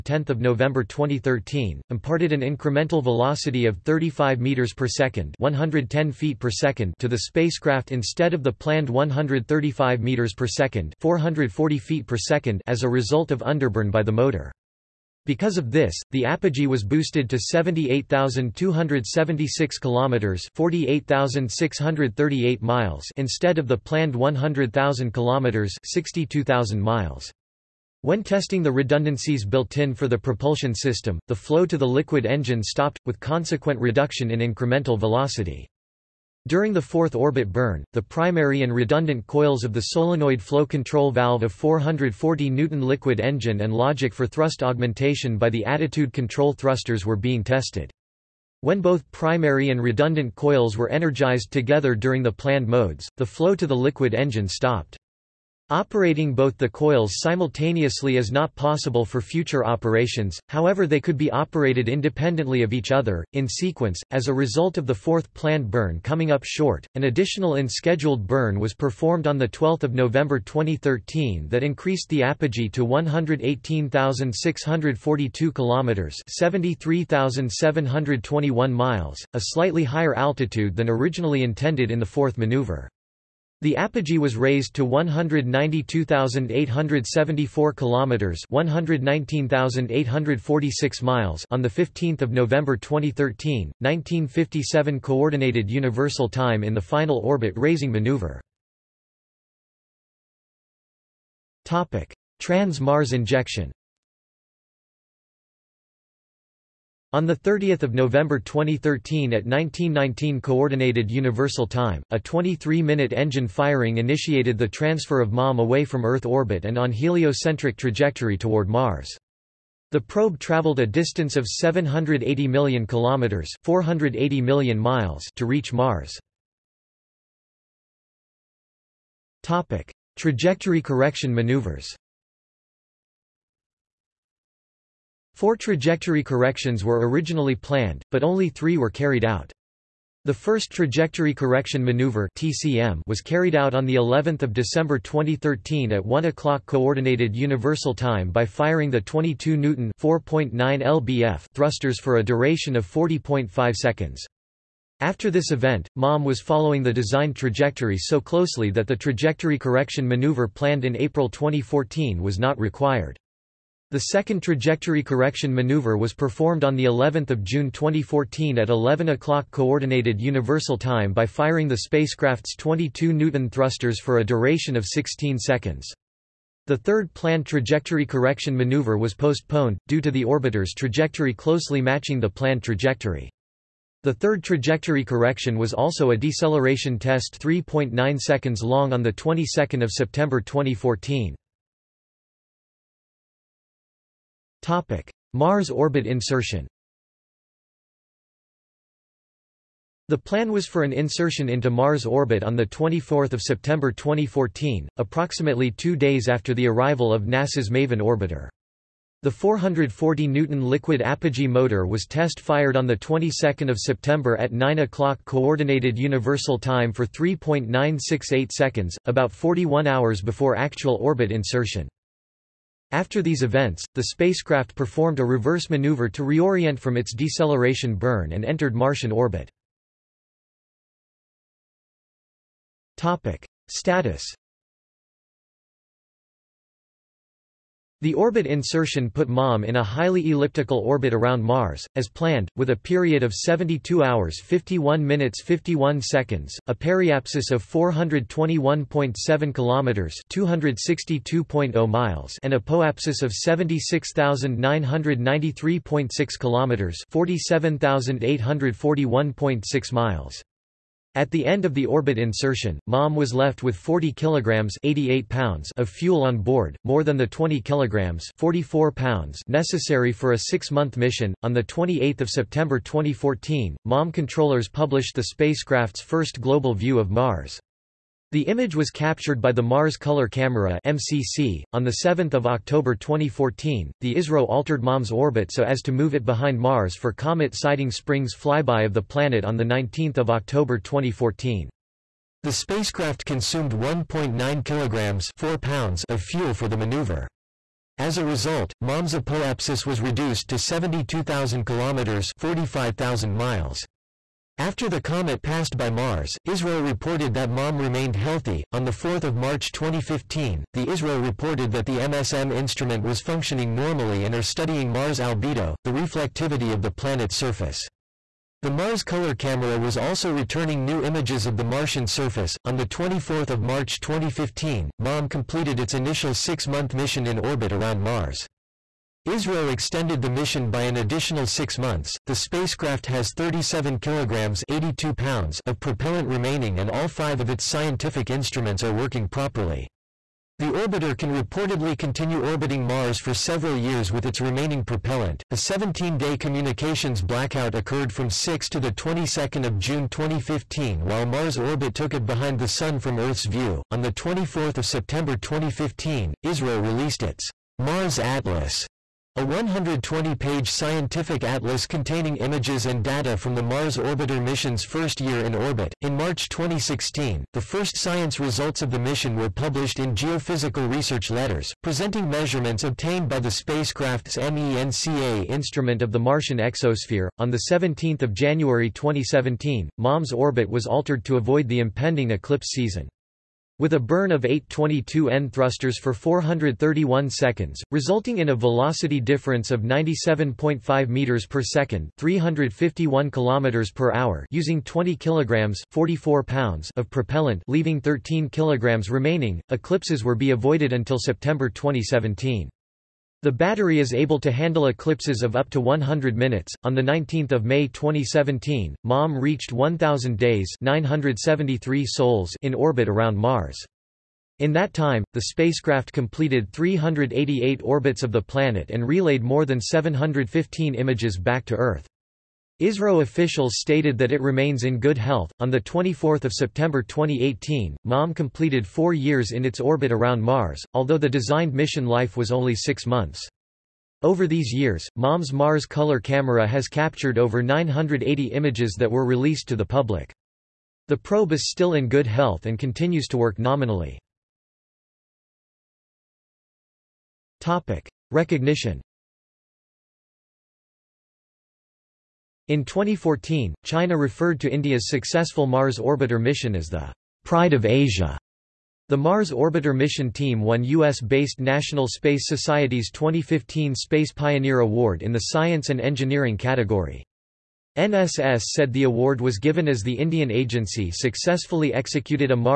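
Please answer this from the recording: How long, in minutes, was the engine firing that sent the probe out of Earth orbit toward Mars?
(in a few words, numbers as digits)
23 minutes.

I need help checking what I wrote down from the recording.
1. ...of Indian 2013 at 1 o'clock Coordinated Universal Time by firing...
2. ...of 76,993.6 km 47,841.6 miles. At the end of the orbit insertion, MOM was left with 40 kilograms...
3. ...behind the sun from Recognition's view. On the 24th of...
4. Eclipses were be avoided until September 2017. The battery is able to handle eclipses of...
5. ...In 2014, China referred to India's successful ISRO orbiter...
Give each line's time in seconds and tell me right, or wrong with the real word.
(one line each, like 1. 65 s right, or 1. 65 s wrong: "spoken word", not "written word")
1. 144 s wrong: "December", not "Indian"
2. 253 s right
3. 352 s wrong: "Earth", not "Recognition"
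4. 399 s right
5. 452 s wrong: "Mars", not "ISRO".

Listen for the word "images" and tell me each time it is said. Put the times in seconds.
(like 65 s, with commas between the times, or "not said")
278 s, 321 s, 362 s, 420 s, 438 s.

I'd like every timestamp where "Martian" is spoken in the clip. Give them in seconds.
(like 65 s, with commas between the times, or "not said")
228 s, 321 s, 376 s.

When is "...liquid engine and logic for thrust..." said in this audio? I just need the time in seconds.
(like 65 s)
42 s.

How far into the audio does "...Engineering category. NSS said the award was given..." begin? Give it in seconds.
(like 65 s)
466 s.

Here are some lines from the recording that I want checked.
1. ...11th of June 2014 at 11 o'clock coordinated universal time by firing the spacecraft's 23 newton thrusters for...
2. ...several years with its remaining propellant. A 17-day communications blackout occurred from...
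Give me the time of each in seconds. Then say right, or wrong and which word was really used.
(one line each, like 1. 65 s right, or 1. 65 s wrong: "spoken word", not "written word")
1. 166 s wrong: "22", not "23"
2. 343 s right.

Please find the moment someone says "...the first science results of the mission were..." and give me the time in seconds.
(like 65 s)
367 s.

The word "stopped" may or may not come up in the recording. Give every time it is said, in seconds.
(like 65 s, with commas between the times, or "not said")
32 s, 54 s.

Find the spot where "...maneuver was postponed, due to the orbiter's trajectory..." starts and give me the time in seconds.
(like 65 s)
178 s.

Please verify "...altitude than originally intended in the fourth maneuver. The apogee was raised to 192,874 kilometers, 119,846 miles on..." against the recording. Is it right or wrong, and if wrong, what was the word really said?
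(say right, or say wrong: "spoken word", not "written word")
right.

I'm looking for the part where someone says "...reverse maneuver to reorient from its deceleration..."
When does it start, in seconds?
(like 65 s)
225 s.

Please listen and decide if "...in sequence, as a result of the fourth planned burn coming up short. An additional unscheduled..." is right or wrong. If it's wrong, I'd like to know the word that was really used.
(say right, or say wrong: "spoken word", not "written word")
right.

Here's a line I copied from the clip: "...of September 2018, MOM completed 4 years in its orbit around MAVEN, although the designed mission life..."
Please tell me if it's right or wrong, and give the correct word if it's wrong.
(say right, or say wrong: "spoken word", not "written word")
wrong: "Mars", not "MAVEN".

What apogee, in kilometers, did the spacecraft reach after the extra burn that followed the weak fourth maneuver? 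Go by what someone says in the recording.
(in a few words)
118,642 kilometers.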